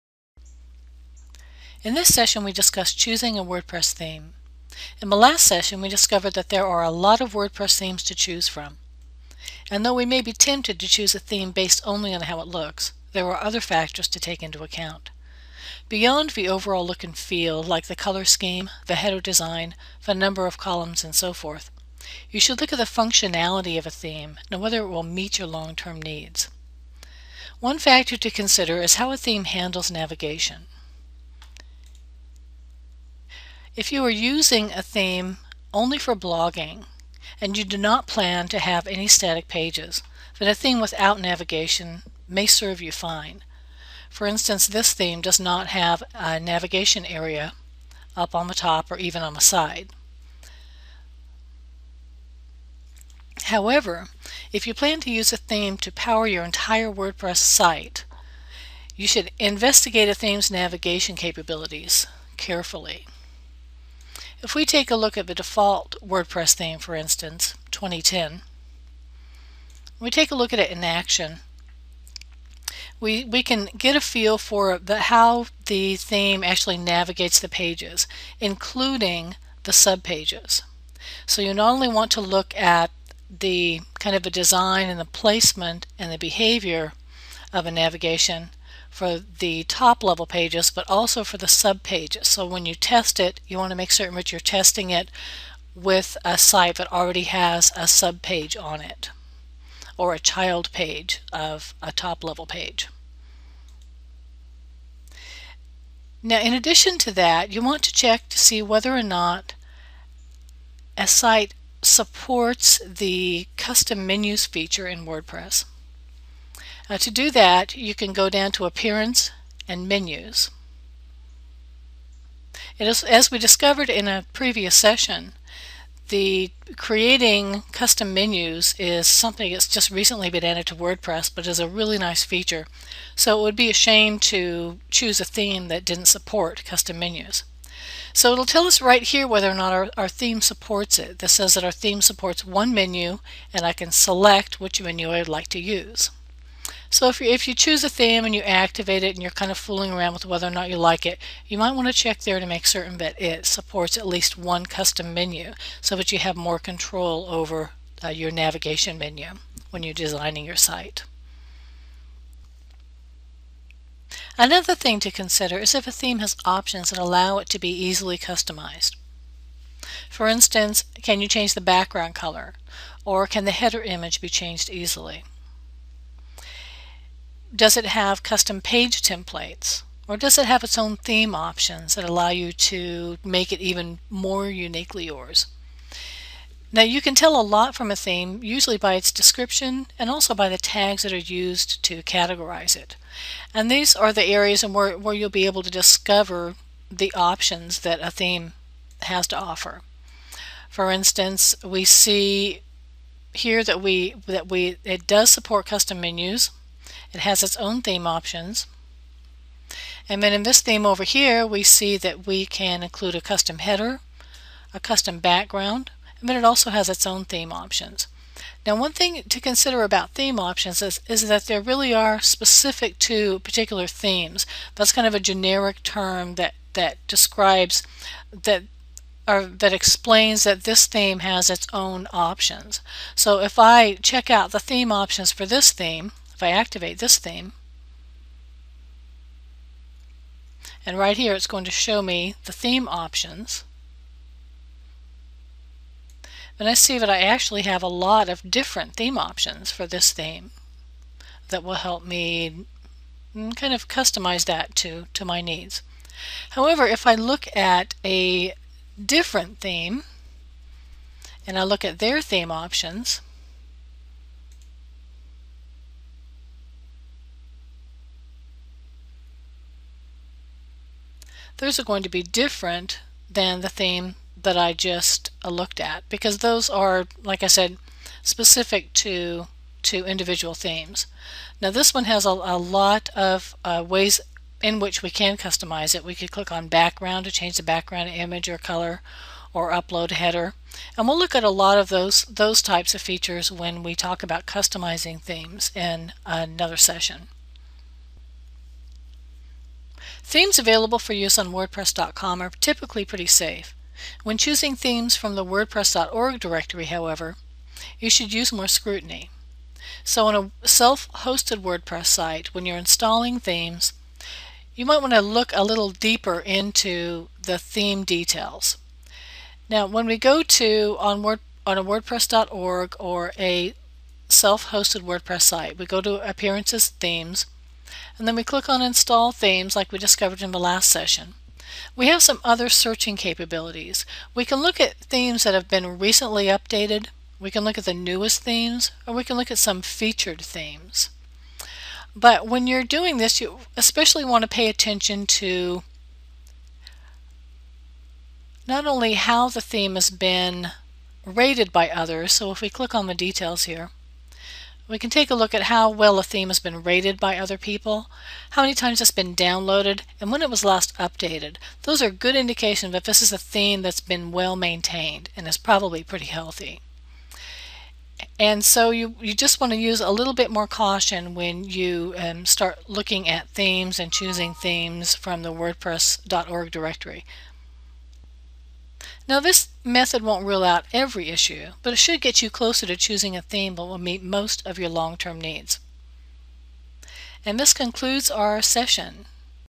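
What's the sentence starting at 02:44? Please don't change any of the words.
Another thing to consider is if a theme has options that allow it to be easily customized.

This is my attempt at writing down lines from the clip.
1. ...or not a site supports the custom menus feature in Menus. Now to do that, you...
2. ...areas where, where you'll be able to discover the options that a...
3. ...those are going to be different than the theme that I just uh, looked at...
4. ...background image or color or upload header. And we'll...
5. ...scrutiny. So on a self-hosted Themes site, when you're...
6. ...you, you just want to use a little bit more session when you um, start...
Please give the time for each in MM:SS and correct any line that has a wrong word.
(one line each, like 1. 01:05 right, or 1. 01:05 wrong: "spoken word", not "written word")
1. 01:48 wrong: "WordPress", not "Menus"
2. 03:14 right
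3. 04:31 right
4. 04:47 right
5. 05:08 wrong: "WordPress", not "Themes"
6. 06:08 wrong: "caution", not "session".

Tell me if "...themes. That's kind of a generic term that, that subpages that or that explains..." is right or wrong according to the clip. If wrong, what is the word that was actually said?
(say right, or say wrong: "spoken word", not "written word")
wrong: "describes", not "subpages".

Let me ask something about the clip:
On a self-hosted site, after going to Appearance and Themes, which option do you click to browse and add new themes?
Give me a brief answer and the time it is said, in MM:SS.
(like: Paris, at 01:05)
Install Themes, at 05:28.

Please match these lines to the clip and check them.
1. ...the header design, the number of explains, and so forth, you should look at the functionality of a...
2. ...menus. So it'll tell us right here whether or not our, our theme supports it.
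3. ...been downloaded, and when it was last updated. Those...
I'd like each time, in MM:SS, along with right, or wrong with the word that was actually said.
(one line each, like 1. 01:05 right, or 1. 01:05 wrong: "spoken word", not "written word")
1. 00:18 wrong: "columns", not "explains"
2. 02:16 right
3. 05:59 right.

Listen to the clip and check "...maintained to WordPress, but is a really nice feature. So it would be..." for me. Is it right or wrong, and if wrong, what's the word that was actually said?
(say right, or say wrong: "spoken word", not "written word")
wrong: "added", not "maintained".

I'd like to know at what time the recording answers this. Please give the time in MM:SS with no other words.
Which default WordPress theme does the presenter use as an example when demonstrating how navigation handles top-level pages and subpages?
01:07.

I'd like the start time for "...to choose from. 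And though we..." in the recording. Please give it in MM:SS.
00:08.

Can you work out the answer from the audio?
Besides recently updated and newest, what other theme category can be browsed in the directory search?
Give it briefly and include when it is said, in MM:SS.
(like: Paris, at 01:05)
Featured themes, at 05:39.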